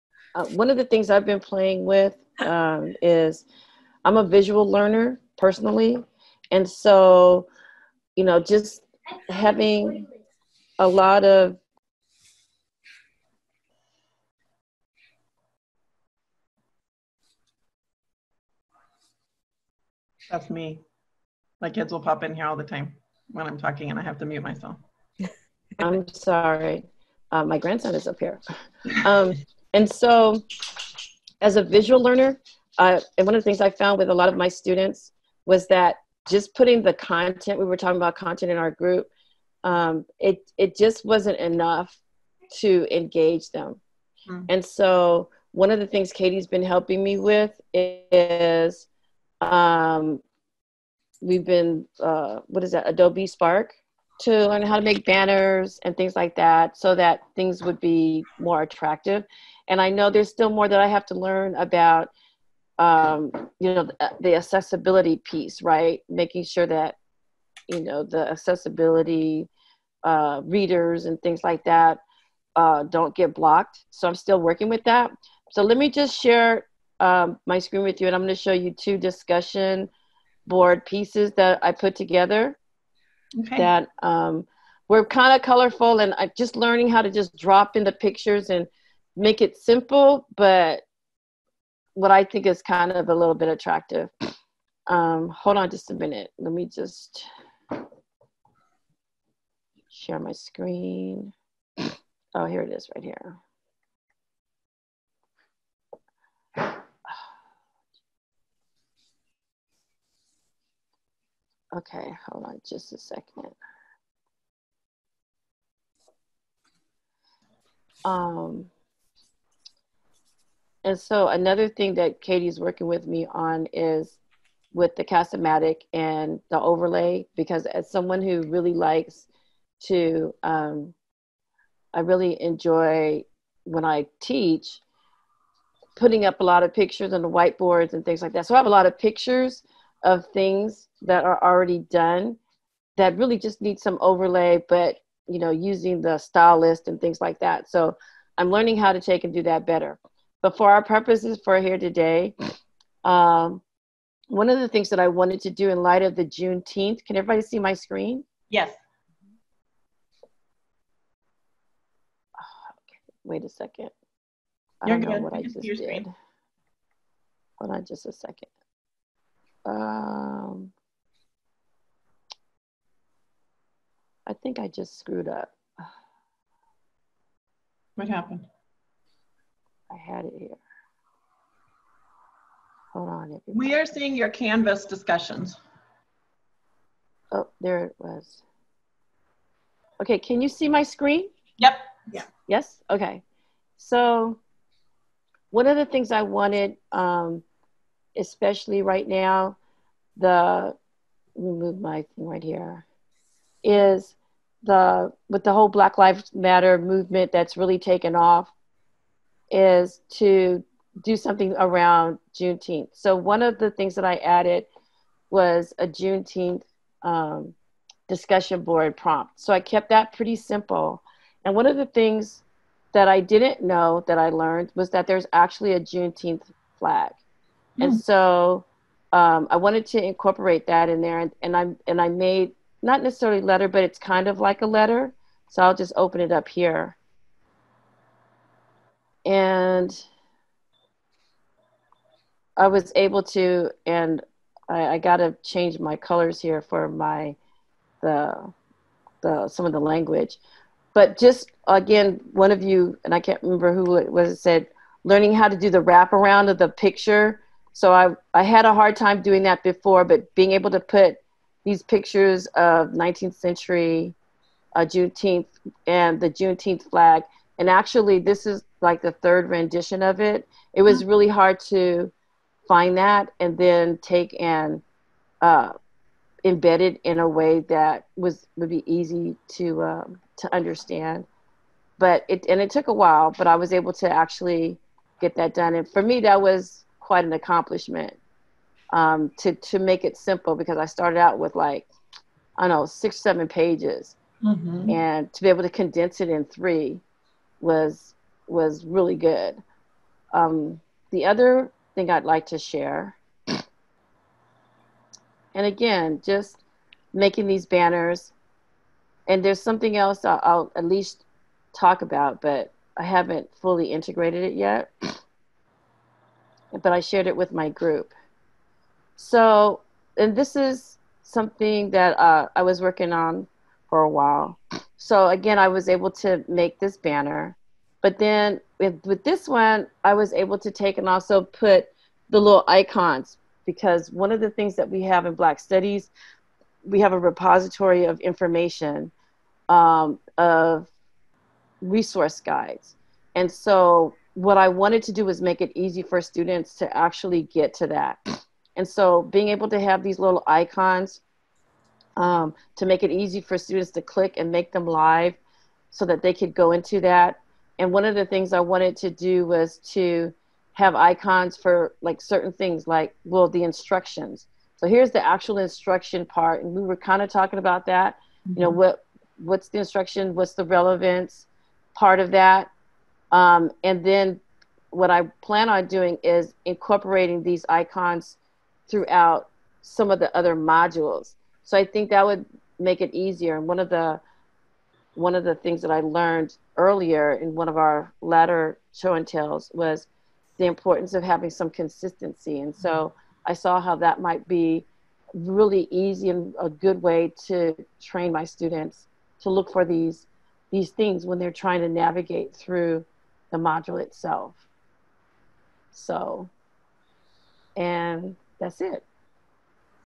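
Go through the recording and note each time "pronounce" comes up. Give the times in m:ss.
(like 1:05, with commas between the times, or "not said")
not said.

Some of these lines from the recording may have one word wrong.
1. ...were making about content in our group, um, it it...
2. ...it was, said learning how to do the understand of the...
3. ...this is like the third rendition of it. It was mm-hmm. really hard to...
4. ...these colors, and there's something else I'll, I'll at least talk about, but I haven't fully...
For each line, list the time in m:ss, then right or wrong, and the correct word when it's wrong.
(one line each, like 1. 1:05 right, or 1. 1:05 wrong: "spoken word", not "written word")
1. 0:37 wrong: "talking", not "making"
2. 4:13 wrong: "wraparound", not "understand"
3. 4:28 right
4. 5:07 wrong: "banners", not "colors".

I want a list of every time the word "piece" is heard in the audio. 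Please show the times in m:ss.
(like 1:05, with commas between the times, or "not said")
1:05, 1:20.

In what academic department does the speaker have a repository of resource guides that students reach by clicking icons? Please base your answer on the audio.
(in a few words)
Black Studies.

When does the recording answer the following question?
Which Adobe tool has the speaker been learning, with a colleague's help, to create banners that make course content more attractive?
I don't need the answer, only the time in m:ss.
0:52.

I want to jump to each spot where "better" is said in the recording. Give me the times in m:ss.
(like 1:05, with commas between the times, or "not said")
2:29.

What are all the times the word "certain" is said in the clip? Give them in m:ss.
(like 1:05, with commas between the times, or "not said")
6:02.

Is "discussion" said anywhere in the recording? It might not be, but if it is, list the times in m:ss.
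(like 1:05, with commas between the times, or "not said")
1:18, 3:04, 3:38.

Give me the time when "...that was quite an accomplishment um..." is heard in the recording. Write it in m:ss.
4:46.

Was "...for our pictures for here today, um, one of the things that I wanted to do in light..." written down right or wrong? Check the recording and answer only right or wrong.
wrong.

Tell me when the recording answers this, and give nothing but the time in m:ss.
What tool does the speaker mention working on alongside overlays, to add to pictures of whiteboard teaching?
2:05.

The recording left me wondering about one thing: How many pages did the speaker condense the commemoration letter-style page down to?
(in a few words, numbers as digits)
3.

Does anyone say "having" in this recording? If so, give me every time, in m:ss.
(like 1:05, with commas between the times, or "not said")
0:09, 6:31.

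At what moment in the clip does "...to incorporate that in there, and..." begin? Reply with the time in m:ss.
3:49.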